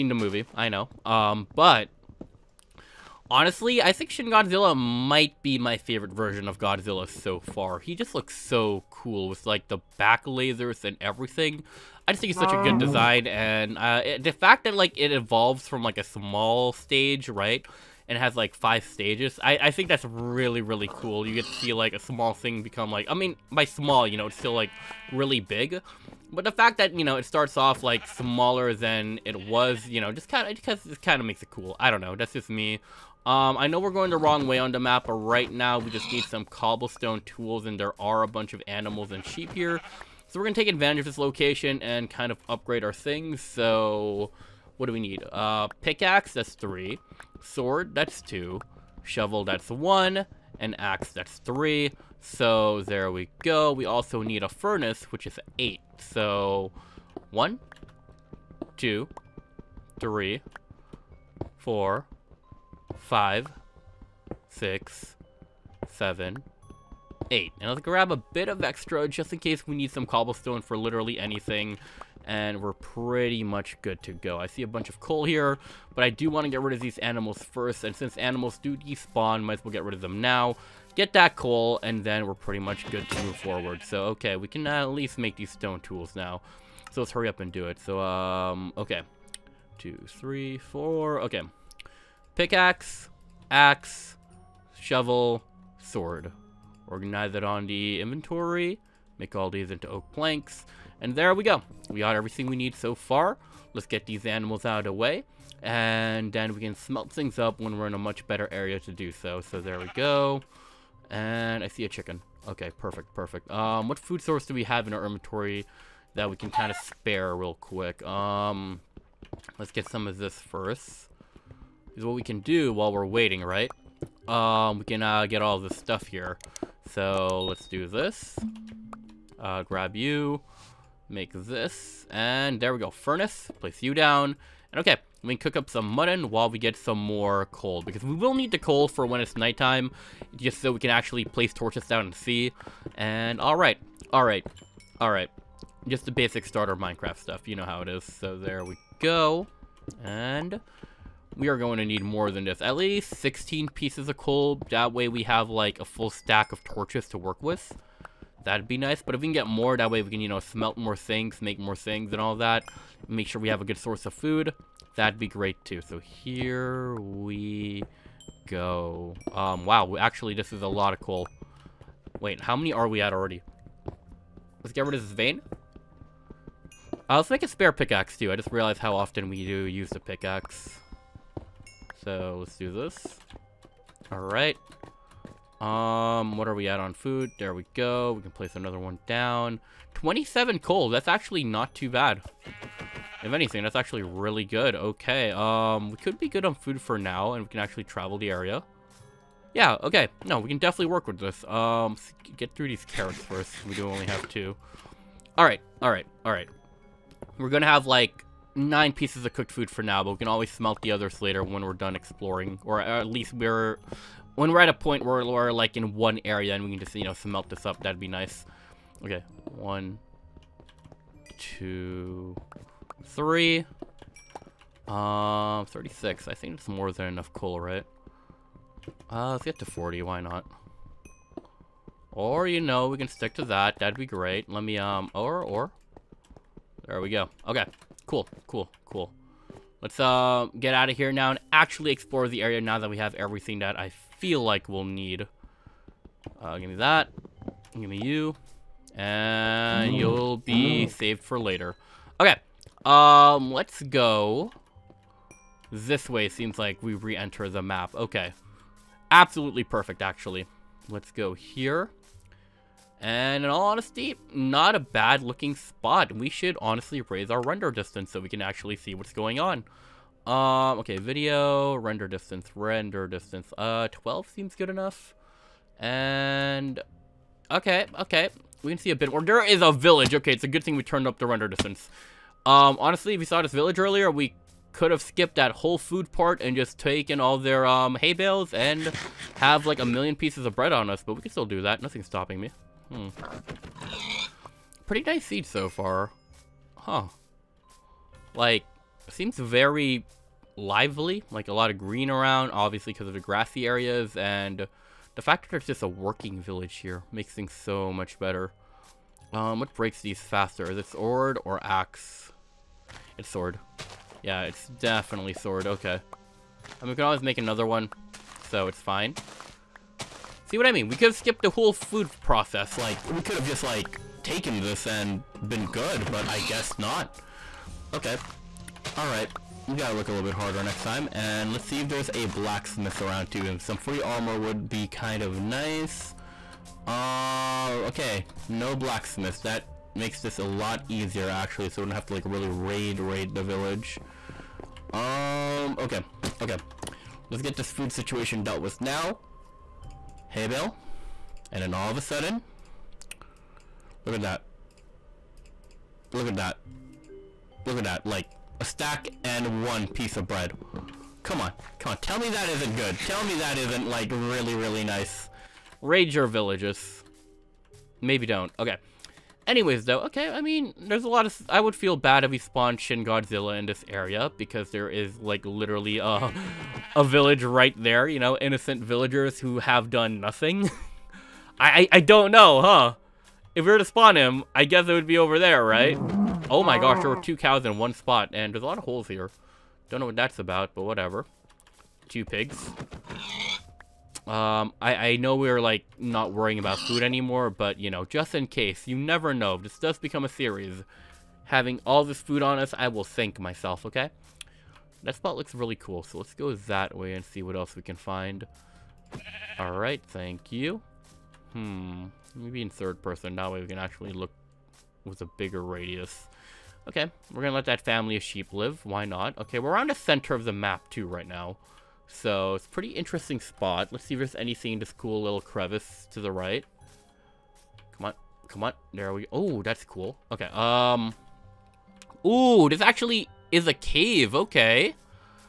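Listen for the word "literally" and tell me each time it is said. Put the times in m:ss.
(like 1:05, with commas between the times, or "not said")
1:10, 6:15.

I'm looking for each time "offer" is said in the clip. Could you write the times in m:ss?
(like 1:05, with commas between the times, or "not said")
not said.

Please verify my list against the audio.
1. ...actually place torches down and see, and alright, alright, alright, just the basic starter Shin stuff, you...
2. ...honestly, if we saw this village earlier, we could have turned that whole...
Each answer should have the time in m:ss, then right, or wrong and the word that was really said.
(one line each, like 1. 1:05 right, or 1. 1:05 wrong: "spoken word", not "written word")
1. 2:20 wrong: "Minecraft", not "Shin"
2. 4:42 wrong: "skipped", not "turned".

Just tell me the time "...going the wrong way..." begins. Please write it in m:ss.
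0:33.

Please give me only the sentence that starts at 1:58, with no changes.
Um, let's get some of this first.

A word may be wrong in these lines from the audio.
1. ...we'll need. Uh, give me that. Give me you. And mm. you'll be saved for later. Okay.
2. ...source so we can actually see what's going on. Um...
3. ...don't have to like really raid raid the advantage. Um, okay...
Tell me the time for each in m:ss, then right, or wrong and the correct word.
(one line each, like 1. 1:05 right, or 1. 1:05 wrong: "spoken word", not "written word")
1. 4:04 right
2. 4:27 wrong: "distance", not "source"
3. 5:41 wrong: "village", not "advantage".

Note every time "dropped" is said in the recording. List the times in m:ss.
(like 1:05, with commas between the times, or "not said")
not said.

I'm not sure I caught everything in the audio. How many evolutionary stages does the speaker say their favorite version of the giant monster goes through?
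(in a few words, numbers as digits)
5.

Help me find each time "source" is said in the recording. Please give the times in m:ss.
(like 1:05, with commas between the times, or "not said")
1:54, 2:43.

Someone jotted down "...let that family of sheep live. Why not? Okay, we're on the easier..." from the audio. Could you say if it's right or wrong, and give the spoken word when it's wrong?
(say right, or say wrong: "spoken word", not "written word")
wrong: "center", not "easier".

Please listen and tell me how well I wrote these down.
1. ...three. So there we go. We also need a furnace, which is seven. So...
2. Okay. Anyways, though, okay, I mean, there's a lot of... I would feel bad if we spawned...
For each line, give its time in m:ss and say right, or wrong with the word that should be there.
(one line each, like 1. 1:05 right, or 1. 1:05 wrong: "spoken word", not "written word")
1. 0:51 wrong: "eight", not "seven"
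2. 6:08 right.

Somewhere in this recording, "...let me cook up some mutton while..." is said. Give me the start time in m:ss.
2:15.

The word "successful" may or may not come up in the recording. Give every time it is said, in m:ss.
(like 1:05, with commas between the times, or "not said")
not said.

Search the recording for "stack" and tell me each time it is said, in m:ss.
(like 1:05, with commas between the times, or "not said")
2:36, 5:58.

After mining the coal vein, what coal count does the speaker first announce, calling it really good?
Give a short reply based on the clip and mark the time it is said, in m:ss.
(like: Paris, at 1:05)
27, at 3:09.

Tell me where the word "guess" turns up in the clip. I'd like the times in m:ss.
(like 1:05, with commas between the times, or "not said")
5:26, 6:24.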